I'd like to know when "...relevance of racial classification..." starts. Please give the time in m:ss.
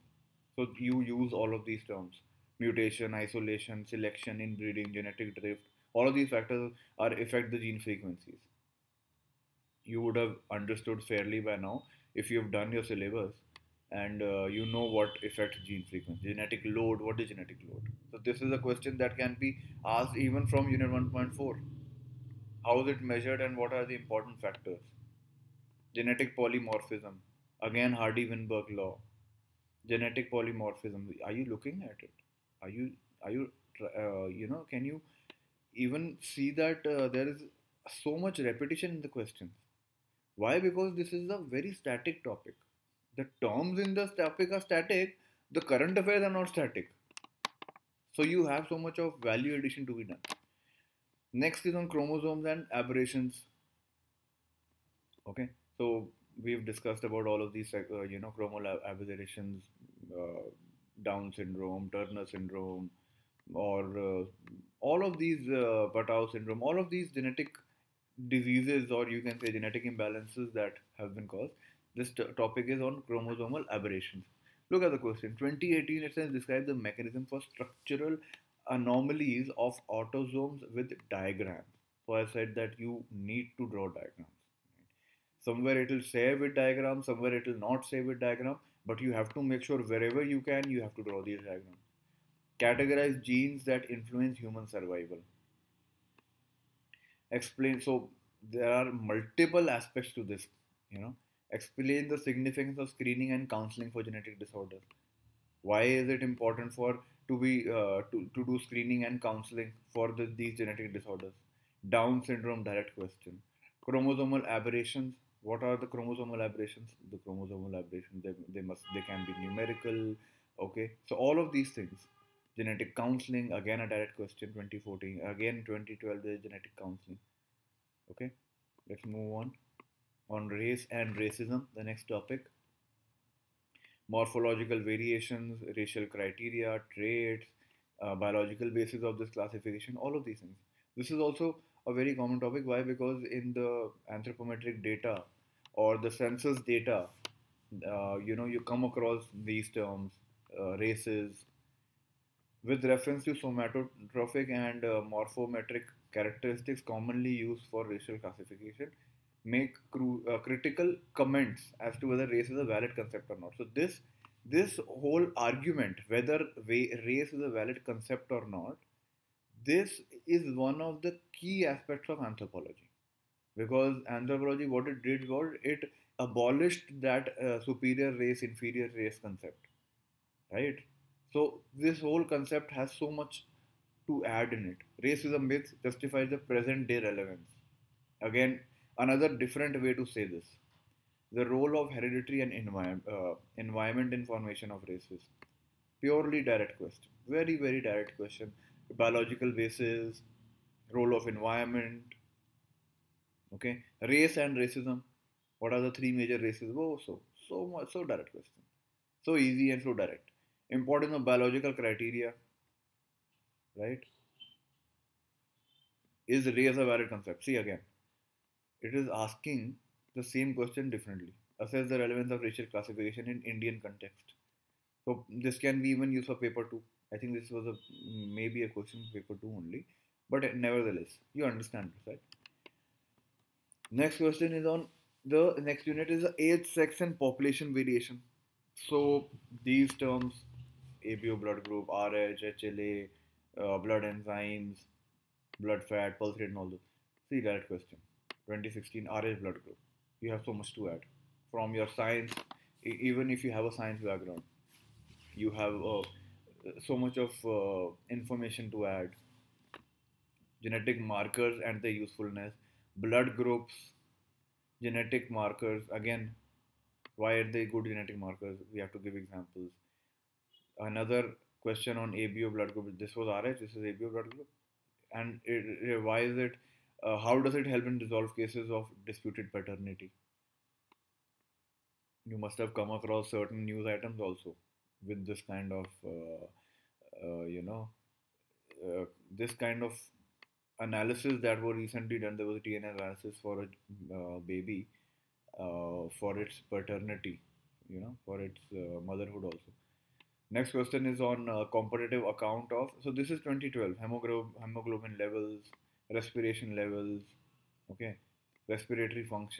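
3:41.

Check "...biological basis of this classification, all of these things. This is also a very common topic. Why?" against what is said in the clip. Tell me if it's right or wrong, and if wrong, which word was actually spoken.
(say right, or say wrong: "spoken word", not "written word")
right.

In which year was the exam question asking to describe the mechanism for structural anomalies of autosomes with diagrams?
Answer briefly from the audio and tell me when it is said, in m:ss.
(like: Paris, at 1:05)
2018, at 1:15.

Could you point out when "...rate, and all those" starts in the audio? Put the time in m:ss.
4:06.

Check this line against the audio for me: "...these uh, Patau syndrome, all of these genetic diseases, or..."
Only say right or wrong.
right.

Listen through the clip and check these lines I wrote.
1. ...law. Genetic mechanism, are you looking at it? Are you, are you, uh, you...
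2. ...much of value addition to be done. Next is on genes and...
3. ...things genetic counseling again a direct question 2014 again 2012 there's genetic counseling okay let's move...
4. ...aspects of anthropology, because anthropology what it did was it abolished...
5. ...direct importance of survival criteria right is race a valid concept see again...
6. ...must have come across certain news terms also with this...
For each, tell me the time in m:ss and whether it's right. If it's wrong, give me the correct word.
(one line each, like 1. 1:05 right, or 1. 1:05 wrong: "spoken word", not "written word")
1. 0:28 wrong: "polymorphism", not "mechanism"
2. 0:48 wrong: "chromosomes", not "genes"
3. 2:01 right
4. 2:51 right
5. 3:29 wrong: "biological", not "survival"
6. 4:42 wrong: "items", not "terms".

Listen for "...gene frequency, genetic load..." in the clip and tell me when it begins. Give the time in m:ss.
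0:15.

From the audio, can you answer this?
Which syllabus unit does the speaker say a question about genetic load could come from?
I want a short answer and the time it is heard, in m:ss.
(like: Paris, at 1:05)
Unit 1.4, at 0:20.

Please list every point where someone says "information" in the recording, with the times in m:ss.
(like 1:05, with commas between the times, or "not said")
3:14, 4:18.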